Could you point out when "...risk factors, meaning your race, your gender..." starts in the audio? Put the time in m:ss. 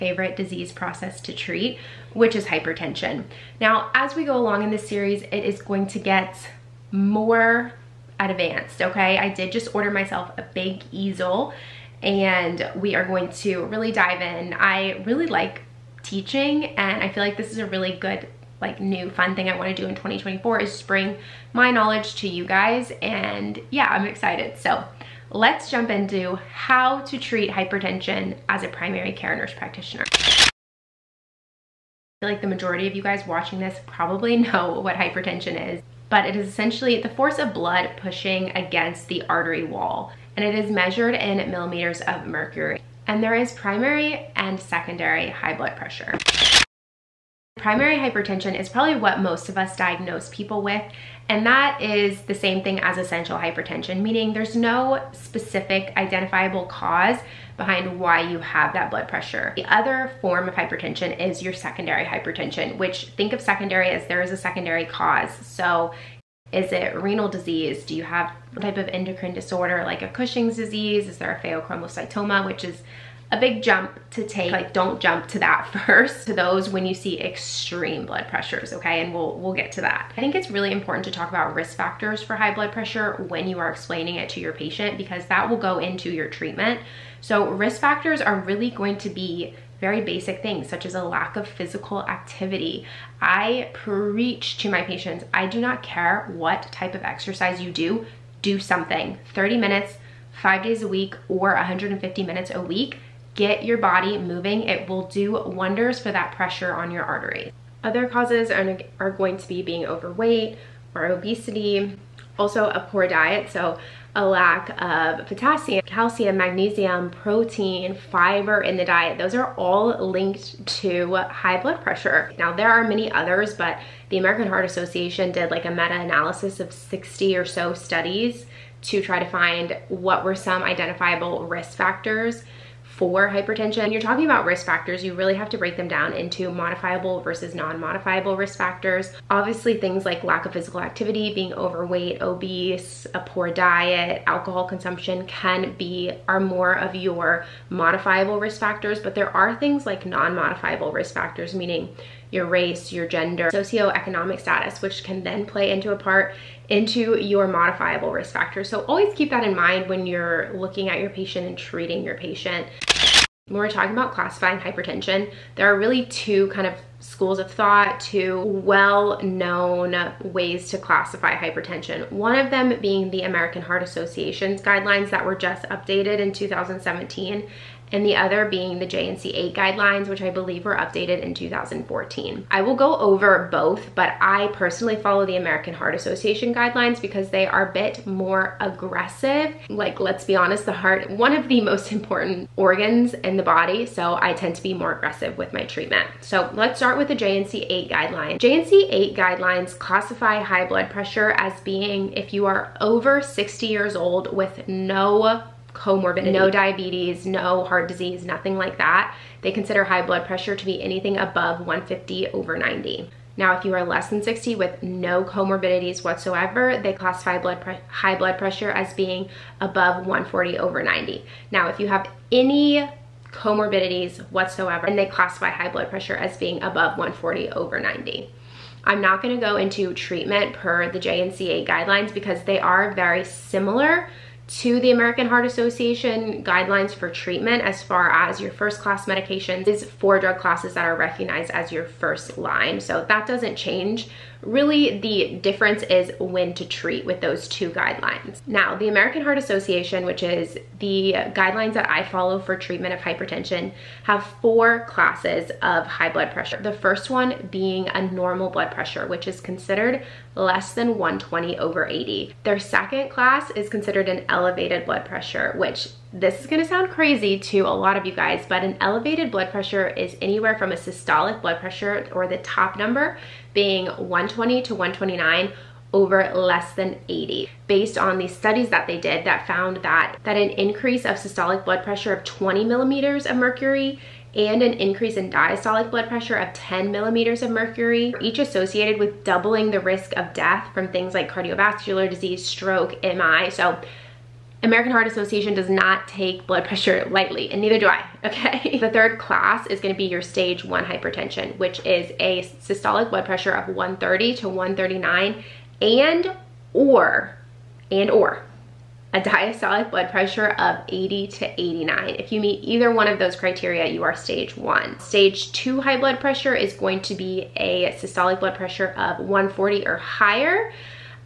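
2:30.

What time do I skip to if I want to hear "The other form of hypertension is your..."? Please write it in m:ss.
0:59.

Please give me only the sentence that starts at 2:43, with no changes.
When we're talking about classifying hypertension, there are really two kind of schools of thought, two well-known ways to classify hypertension.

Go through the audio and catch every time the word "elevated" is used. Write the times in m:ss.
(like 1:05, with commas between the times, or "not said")
4:24, 4:28.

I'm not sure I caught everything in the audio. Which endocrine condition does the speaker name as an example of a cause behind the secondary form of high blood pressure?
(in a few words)
Cushing's disease.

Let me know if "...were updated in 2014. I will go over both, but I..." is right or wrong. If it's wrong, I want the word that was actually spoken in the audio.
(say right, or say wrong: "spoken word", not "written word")
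right.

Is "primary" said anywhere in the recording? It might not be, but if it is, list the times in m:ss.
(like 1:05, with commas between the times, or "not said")
0:28, 0:43, 0:47.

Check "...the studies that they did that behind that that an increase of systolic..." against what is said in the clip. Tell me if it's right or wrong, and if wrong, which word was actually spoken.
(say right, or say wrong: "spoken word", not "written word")
wrong: "found", not "behind".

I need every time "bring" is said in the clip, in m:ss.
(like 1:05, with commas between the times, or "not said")
0:20.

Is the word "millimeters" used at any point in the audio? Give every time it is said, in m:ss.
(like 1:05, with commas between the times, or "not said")
0:41, 4:42, 4:46.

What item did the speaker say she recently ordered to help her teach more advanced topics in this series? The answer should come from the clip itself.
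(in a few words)
big easel.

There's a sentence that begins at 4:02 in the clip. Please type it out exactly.
So that doesn't change Really, the difference is when to treat with those two guidelines.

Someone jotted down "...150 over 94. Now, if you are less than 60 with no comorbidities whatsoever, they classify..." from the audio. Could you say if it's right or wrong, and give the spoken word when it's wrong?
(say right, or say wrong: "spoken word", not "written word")
wrong: "90", not "94".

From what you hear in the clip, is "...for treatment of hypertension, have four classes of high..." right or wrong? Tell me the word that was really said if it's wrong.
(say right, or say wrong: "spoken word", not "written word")
right.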